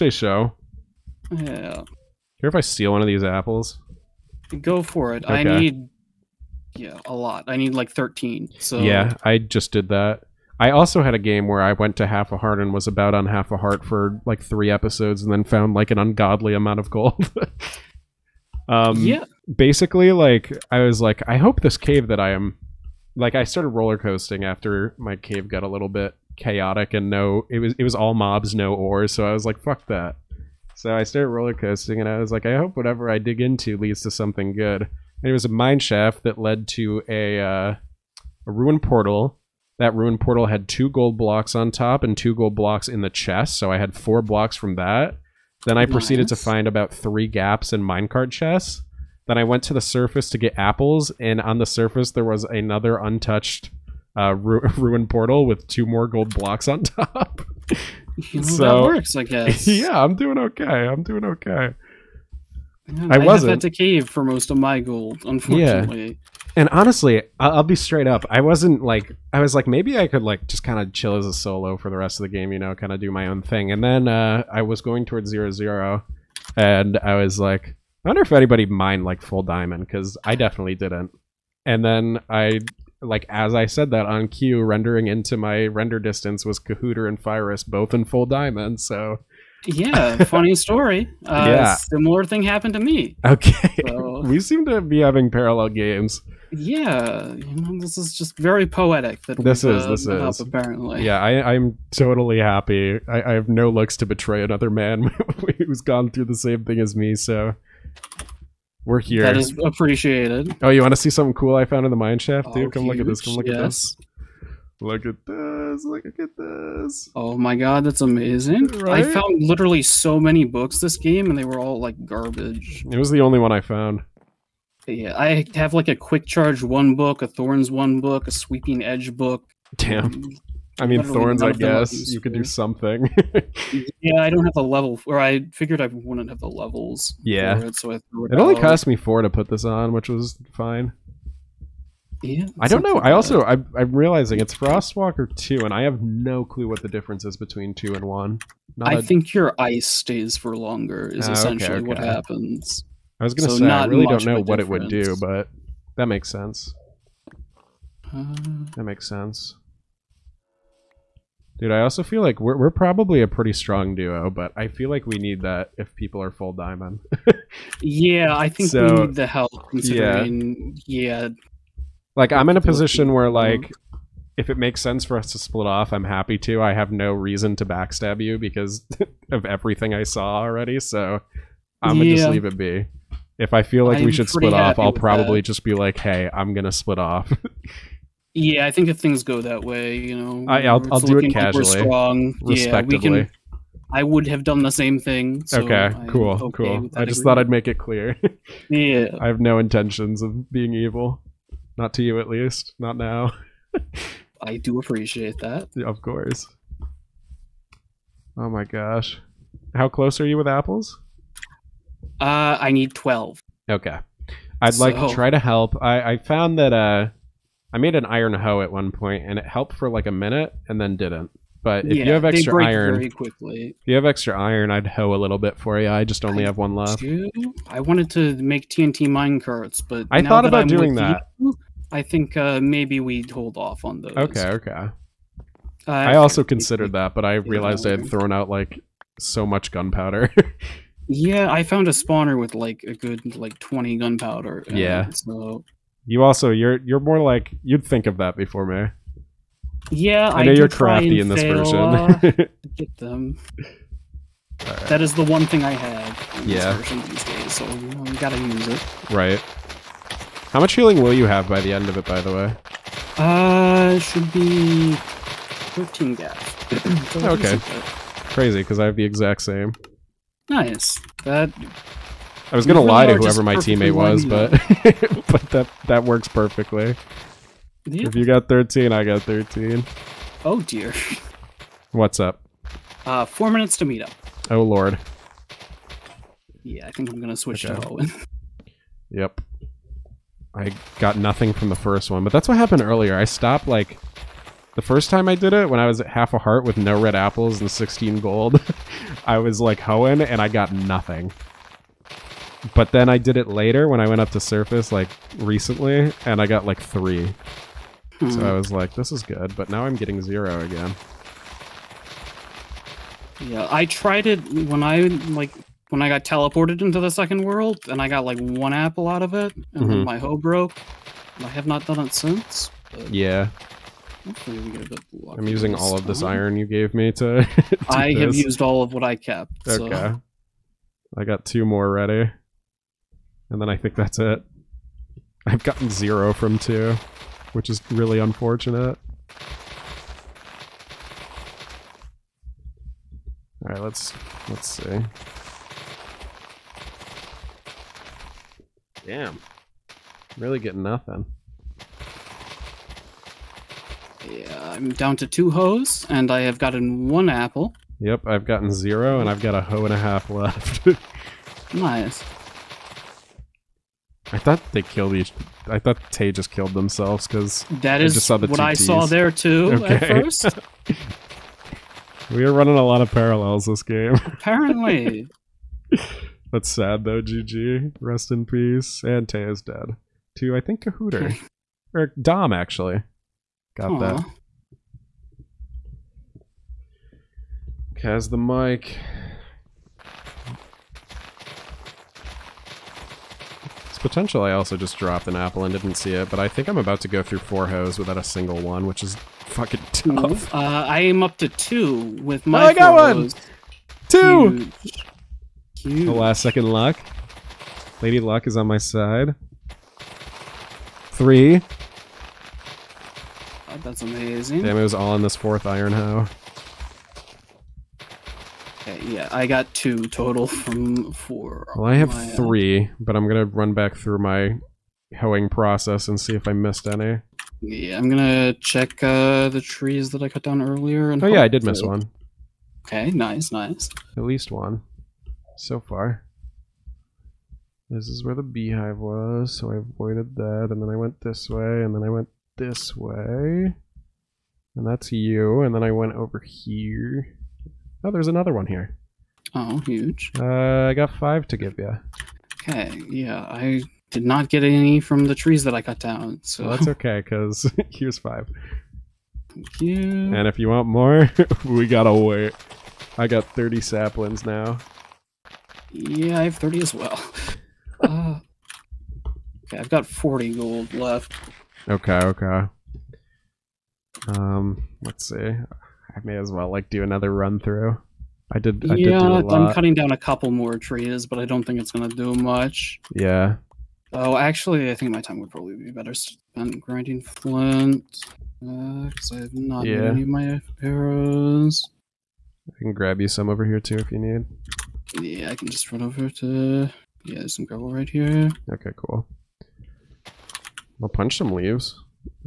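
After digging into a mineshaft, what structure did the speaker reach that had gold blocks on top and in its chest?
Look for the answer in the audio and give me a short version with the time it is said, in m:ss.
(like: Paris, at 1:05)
ruined portal, at 0:38.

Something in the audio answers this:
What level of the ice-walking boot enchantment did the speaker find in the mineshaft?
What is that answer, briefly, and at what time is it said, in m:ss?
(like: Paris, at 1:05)
2, at 2:24.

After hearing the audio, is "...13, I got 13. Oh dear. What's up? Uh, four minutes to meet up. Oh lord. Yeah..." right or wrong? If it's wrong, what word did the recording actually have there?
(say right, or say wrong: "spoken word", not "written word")
right.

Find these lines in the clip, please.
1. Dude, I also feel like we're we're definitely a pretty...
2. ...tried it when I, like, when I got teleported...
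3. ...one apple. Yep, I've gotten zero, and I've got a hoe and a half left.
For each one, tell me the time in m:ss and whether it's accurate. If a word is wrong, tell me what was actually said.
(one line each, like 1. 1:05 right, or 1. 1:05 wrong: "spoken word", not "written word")
1. 2:41 wrong: "probably", not "definitely"
2. 5:13 right
3. 5:57 right.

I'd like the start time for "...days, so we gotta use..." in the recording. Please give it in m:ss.
4:17.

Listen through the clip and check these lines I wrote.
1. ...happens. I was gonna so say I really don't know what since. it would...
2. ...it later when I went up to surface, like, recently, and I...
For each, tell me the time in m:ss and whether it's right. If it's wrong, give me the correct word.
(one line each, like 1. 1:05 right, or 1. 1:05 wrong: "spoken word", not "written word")
1. 2:31 wrong: "difference", not "since"
2. 5:03 right.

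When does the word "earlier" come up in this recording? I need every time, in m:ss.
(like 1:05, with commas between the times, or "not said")
4:52, 7:10.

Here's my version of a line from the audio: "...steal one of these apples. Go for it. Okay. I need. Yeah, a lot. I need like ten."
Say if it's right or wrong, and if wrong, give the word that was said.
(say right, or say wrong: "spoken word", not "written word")
wrong: "thirteen", not "ten".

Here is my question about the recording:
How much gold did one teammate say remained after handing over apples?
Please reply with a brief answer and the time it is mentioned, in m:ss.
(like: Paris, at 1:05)
40, at 7:50.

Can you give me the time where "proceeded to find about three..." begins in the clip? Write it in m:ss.
0:45.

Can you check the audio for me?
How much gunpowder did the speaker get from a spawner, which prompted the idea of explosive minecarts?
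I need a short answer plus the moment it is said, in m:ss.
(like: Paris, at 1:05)
20, at 4:03.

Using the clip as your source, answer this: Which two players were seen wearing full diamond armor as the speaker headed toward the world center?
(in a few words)
Kahooter and Fyrus.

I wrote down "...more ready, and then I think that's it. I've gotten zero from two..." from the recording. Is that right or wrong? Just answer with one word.
right.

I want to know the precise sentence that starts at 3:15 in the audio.
so okay, I'm cool, okay cool.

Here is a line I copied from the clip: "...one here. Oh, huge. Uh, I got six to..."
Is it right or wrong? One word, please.
wrong.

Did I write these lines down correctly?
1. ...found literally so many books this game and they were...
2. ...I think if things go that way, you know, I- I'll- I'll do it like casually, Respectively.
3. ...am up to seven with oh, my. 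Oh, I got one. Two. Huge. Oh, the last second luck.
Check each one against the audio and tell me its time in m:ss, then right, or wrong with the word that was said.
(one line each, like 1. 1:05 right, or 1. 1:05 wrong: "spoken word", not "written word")
1. 1:59 right
2. 3:08 right
3. 6:41 wrong: "two", not "seven".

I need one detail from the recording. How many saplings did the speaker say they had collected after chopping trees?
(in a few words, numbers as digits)
30.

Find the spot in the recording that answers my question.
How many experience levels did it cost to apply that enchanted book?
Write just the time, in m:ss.
2:18.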